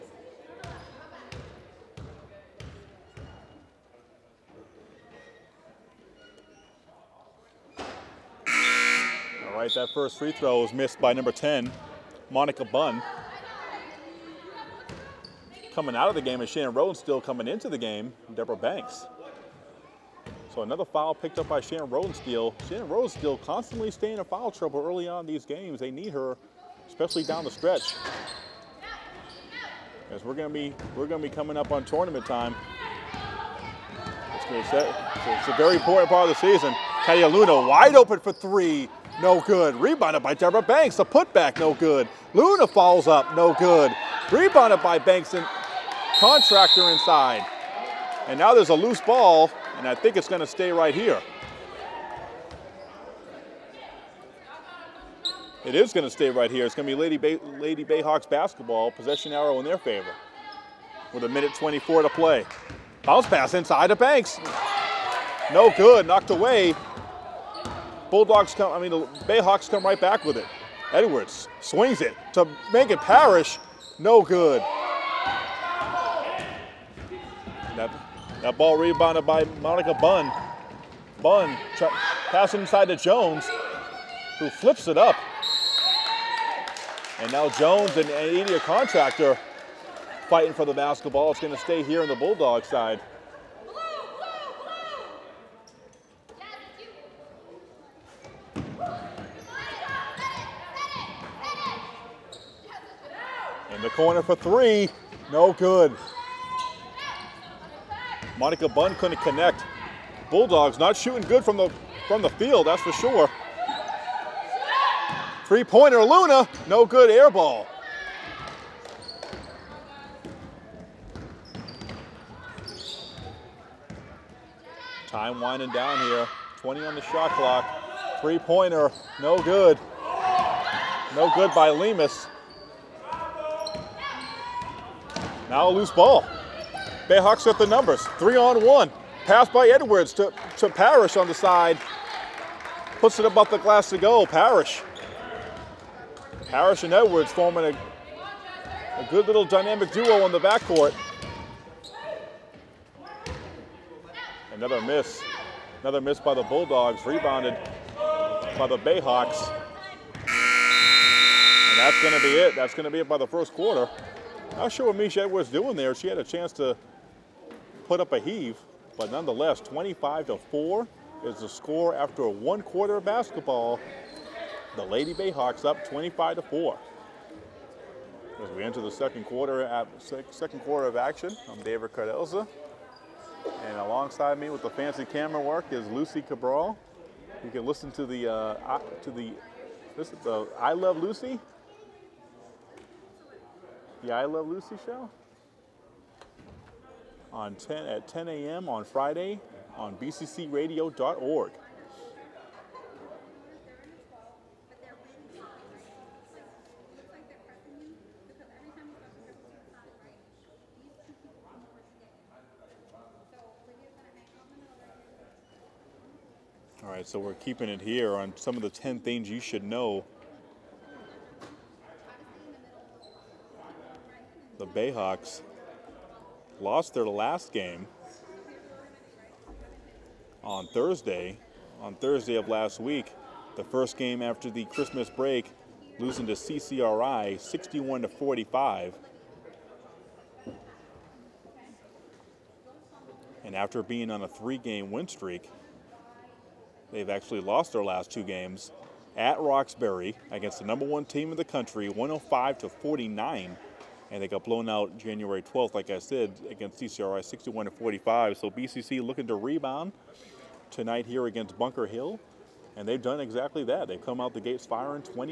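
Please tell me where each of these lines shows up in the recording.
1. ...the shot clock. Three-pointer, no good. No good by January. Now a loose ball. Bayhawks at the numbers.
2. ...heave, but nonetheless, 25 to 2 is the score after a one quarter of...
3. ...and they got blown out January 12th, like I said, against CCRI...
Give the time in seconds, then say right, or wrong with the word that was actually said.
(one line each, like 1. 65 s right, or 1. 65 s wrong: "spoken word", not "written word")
1. 126 s wrong: "Lemus", not "January"
2. 168 s wrong: "4", not "2"
3. 254 s right.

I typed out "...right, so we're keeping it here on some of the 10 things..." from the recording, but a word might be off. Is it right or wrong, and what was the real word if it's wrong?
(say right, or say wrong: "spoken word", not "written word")
right.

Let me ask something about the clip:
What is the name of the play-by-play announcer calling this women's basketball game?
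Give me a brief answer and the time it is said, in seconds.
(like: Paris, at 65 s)
David Cardozo, at 181 s.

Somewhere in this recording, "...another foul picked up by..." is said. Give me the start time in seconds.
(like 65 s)
20 s.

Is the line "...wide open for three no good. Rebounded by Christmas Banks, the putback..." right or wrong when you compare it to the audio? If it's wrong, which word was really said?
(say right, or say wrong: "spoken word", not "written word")
wrong: "Deborah", not "Christmas".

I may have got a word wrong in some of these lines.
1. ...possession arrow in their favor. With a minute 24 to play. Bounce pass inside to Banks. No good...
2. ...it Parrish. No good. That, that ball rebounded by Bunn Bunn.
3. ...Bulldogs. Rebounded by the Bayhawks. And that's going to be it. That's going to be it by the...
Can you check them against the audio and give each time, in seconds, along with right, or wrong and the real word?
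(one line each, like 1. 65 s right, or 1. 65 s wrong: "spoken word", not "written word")
1. 58 s right
2. 72 s wrong: "Monica", not "Bunn"
3. 156 s right.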